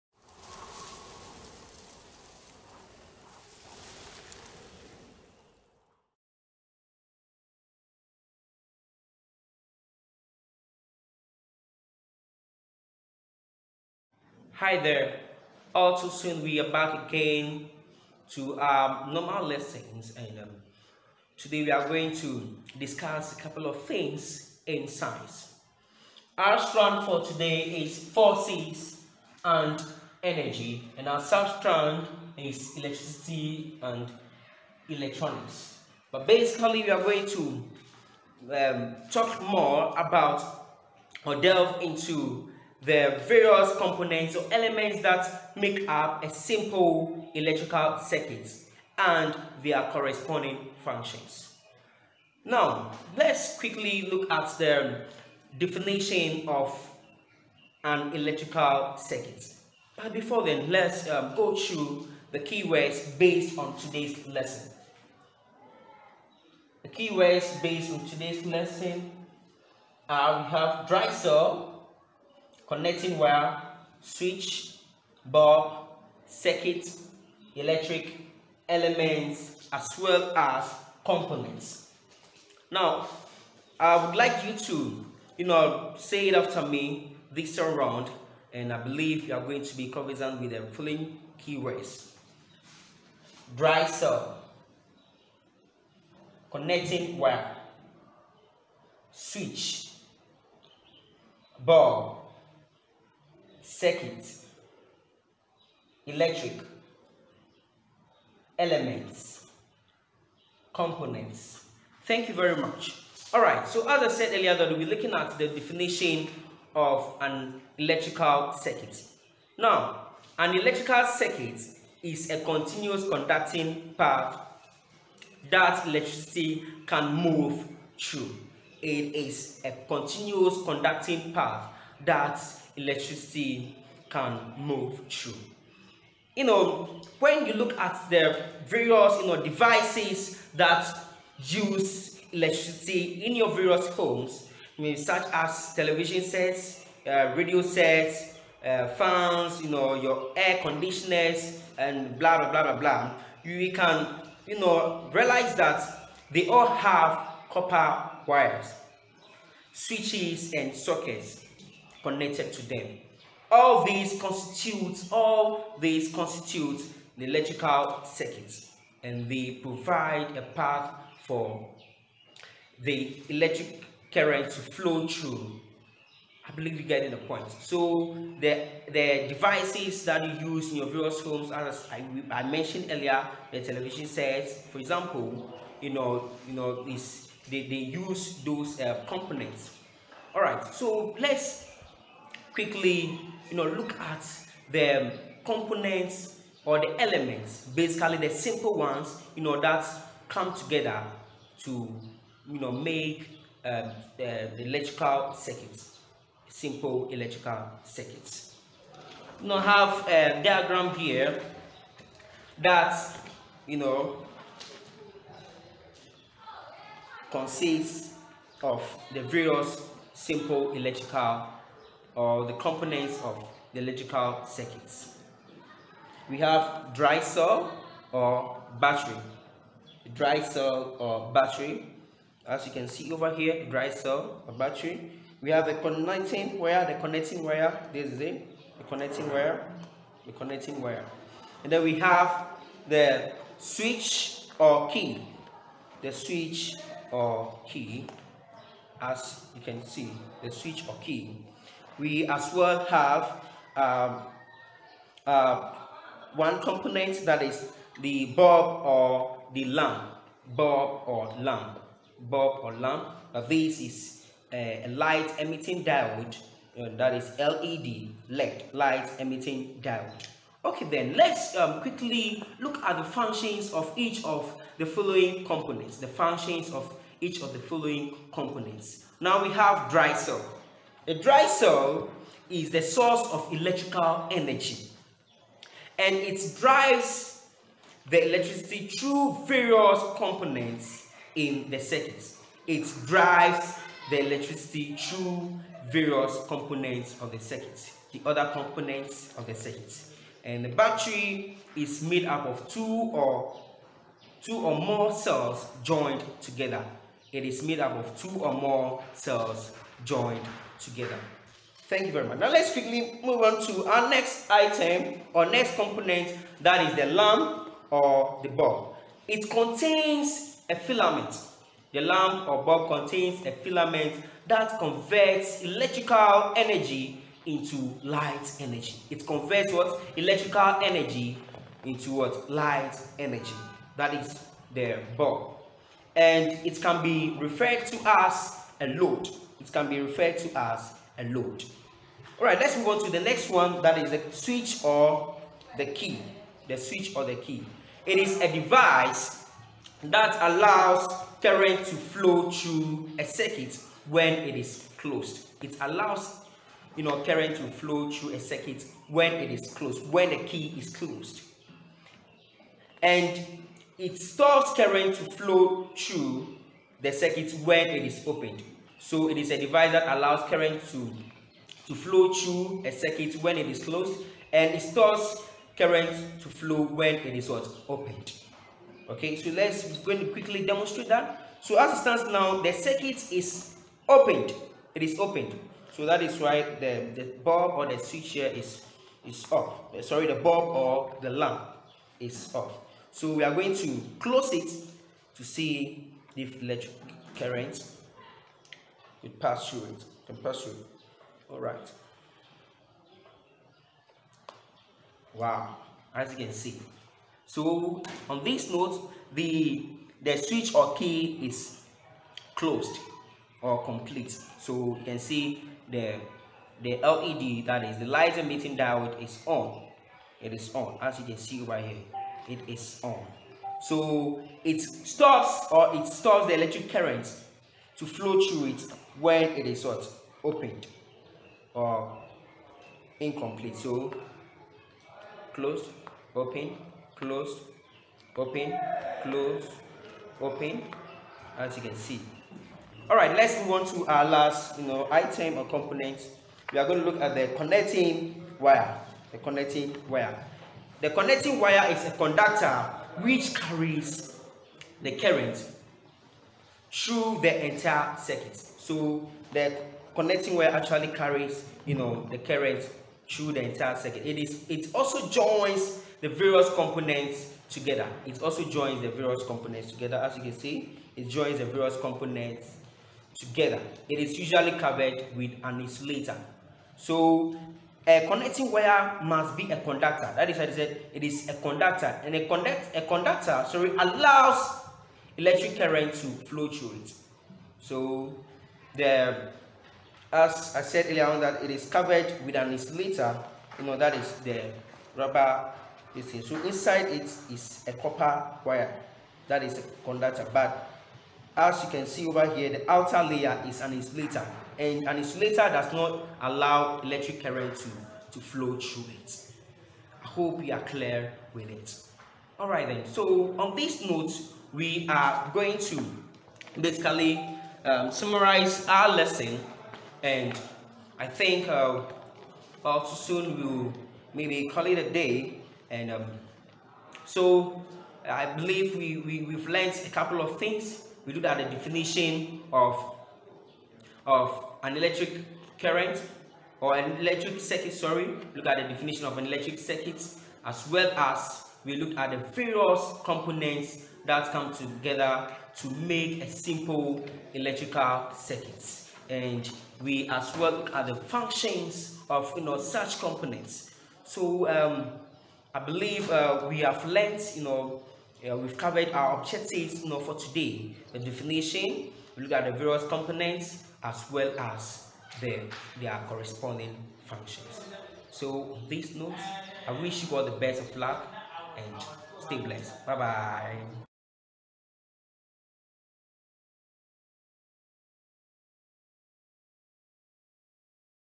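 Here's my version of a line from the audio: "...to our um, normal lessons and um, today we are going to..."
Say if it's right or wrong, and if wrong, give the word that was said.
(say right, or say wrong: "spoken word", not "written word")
right.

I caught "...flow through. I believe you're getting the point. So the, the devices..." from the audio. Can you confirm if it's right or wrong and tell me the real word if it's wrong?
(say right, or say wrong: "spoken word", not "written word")
right.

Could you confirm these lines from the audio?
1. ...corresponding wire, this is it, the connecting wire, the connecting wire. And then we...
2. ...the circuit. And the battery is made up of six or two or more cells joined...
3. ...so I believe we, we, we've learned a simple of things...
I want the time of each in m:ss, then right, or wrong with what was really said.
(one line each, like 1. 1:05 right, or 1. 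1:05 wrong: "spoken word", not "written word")
1. 3:56 wrong: "connecting", not "corresponding"
2. 4:59 wrong: "two", not "six"
3. 8:47 wrong: "couple", not "simple".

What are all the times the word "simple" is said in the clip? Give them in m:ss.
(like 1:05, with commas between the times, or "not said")
0:46, 3:18, 3:26, 3:40, 9:06.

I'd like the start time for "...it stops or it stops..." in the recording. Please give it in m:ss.
7:04.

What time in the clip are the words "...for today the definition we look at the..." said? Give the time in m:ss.
9:20.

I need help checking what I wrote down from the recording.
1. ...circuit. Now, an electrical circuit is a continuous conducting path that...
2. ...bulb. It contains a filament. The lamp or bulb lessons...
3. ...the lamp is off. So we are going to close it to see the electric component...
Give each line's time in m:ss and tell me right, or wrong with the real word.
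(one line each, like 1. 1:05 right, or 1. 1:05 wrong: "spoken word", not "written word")
1. 1:58 right
2. 5:18 wrong: "contains", not "lessons"
3. 6:31 wrong: "current", not "component".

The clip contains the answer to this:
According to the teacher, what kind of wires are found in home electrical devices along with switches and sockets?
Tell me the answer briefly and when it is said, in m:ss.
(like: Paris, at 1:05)
Copper wires, at 2:37.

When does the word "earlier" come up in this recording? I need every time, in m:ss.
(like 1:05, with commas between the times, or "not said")
1:54, 3:02, 8:11.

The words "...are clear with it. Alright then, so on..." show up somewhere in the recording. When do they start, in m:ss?
8:30.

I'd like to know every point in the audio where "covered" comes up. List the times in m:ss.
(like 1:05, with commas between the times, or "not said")
7:54, 8:11, 9:18.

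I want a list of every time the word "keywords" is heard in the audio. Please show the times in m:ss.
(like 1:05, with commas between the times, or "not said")
1:02, 1:06, 1:31.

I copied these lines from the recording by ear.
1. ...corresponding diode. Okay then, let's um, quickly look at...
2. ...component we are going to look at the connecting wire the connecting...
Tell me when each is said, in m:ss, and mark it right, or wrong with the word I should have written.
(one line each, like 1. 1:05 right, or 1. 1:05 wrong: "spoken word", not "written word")
1. 4:29 wrong: "emitting", not "corresponding"
2. 7:25 right.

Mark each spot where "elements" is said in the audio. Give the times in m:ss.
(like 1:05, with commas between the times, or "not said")
0:44, 1:18, 1:48, 3:17.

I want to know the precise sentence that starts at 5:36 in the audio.
And it can be referred to as a load it can be referred to as a load.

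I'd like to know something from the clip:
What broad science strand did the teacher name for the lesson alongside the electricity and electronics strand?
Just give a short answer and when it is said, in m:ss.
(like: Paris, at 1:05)
Forces and energy, at 0:27.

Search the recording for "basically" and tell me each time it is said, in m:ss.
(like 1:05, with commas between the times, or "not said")
0:36, 3:17, 8:36.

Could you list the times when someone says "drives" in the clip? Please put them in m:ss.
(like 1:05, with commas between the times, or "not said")
4:46, 4:53.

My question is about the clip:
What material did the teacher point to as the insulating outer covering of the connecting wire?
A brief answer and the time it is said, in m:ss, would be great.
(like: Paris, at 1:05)
Rubber, at 8:15.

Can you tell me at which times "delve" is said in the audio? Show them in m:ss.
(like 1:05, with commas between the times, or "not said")
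0:41.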